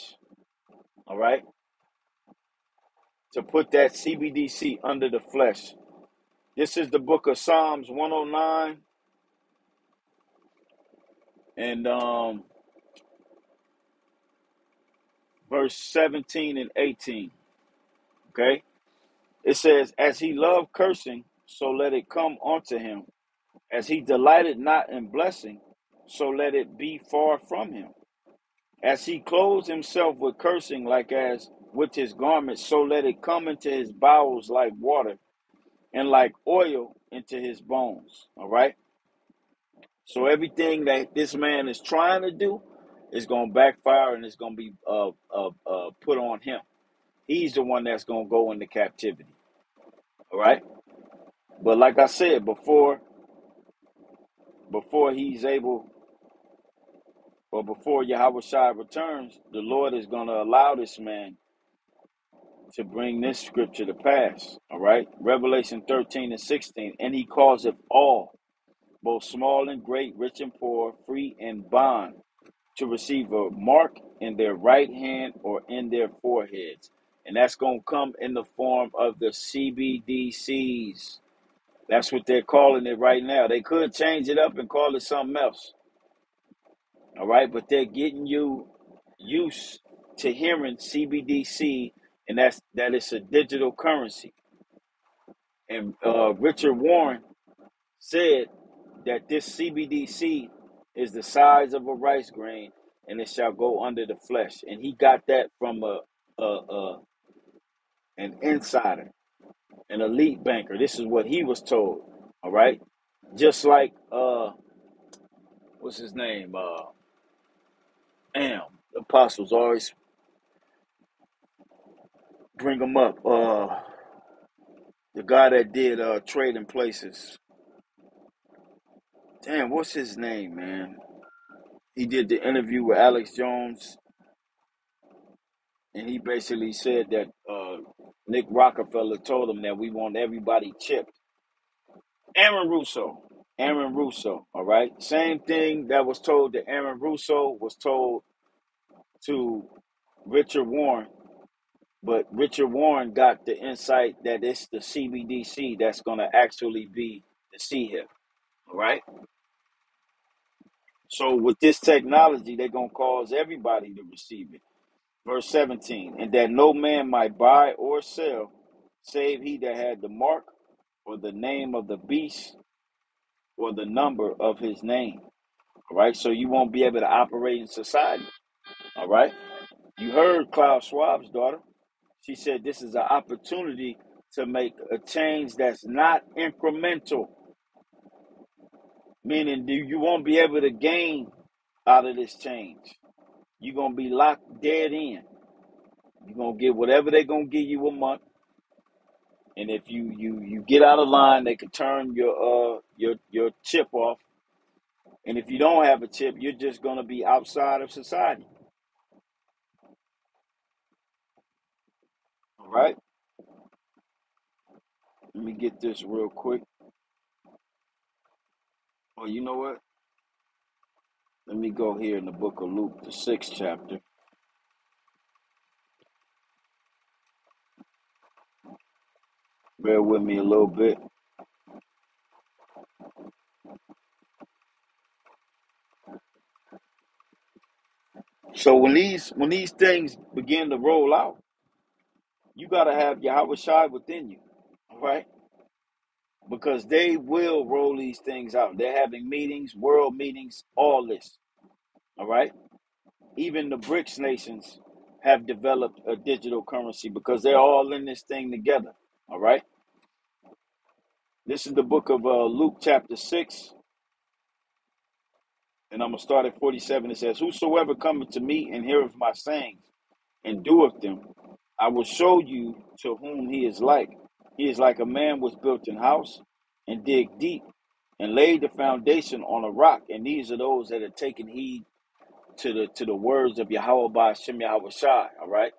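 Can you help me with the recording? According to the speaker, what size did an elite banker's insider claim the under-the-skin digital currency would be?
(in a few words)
a rice grain.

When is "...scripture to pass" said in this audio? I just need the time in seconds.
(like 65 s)
63 s.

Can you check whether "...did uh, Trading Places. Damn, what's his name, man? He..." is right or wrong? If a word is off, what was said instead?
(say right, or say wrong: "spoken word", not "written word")
right.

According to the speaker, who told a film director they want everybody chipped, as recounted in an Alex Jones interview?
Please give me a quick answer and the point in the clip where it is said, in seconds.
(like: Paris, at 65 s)
Nick Rockefeller, at 138 s.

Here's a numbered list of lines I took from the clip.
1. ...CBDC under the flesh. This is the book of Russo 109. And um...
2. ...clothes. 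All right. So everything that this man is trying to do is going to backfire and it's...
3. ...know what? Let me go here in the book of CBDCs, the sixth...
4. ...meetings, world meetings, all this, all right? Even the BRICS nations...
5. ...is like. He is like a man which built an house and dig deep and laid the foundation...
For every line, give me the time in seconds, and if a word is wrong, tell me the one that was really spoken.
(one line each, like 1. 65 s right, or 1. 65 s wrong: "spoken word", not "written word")
1. 3 s wrong: "Psalms", not "Russo"
2. 37 s wrong: "bones", not "clothes"
3. 219 s wrong: "Luke", not "CBDCs"
4. 249 s right
5. 273 s right.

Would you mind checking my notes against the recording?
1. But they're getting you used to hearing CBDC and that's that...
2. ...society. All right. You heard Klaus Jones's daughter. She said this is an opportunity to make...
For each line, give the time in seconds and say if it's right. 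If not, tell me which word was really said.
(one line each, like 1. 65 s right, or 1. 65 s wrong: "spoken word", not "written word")
1. 87 s right
2. 177 s wrong: "Schwab", not "Jones".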